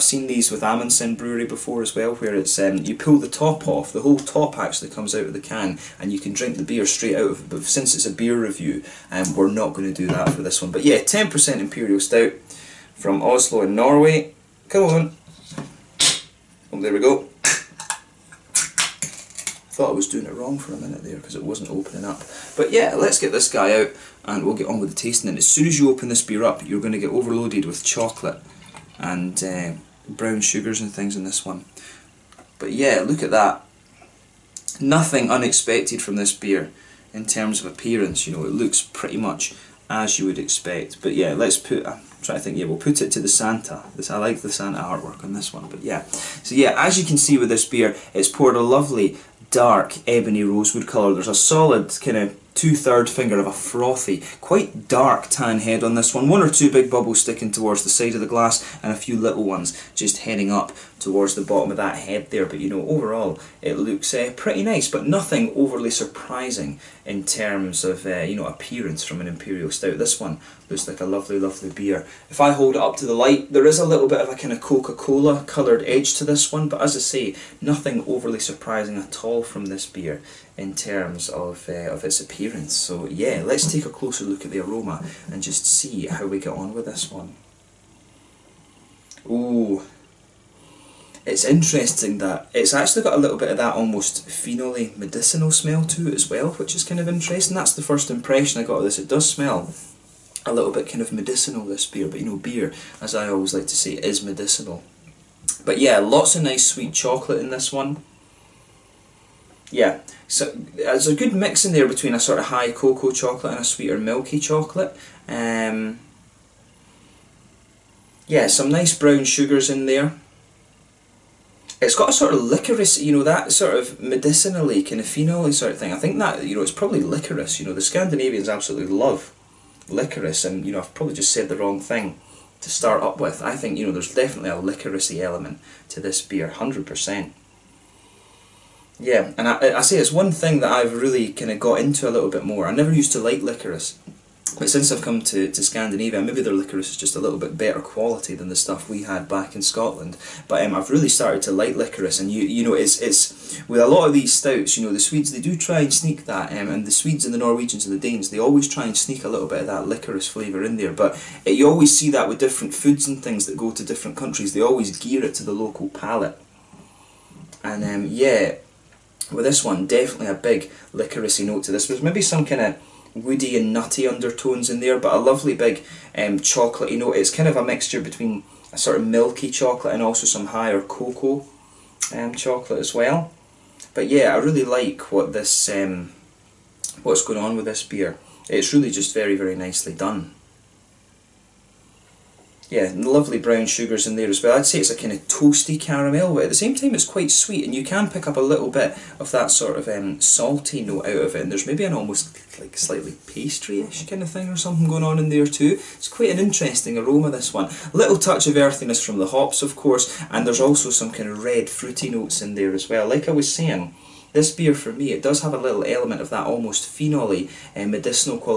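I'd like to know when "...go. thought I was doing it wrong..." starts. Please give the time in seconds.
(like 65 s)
16 s.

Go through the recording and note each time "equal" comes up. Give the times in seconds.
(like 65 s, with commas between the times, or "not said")
not said.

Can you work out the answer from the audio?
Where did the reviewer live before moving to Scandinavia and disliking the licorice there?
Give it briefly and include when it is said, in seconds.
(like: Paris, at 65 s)
Scotland, at 149 s.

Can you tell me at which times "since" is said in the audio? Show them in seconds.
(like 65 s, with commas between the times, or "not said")
7 s, 144 s.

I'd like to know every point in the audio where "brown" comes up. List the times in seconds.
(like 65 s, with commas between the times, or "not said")
30 s, 118 s, 193 s.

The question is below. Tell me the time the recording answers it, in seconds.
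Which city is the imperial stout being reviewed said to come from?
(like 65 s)
13 s.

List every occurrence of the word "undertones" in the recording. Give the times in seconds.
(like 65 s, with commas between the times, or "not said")
174 s.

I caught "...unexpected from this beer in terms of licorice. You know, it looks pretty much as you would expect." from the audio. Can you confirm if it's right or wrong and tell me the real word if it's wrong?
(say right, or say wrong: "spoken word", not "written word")
wrong: "appearance", not "licorice".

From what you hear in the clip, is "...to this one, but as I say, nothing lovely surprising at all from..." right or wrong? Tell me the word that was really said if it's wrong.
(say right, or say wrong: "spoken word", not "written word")
wrong: "overly", not "lovely".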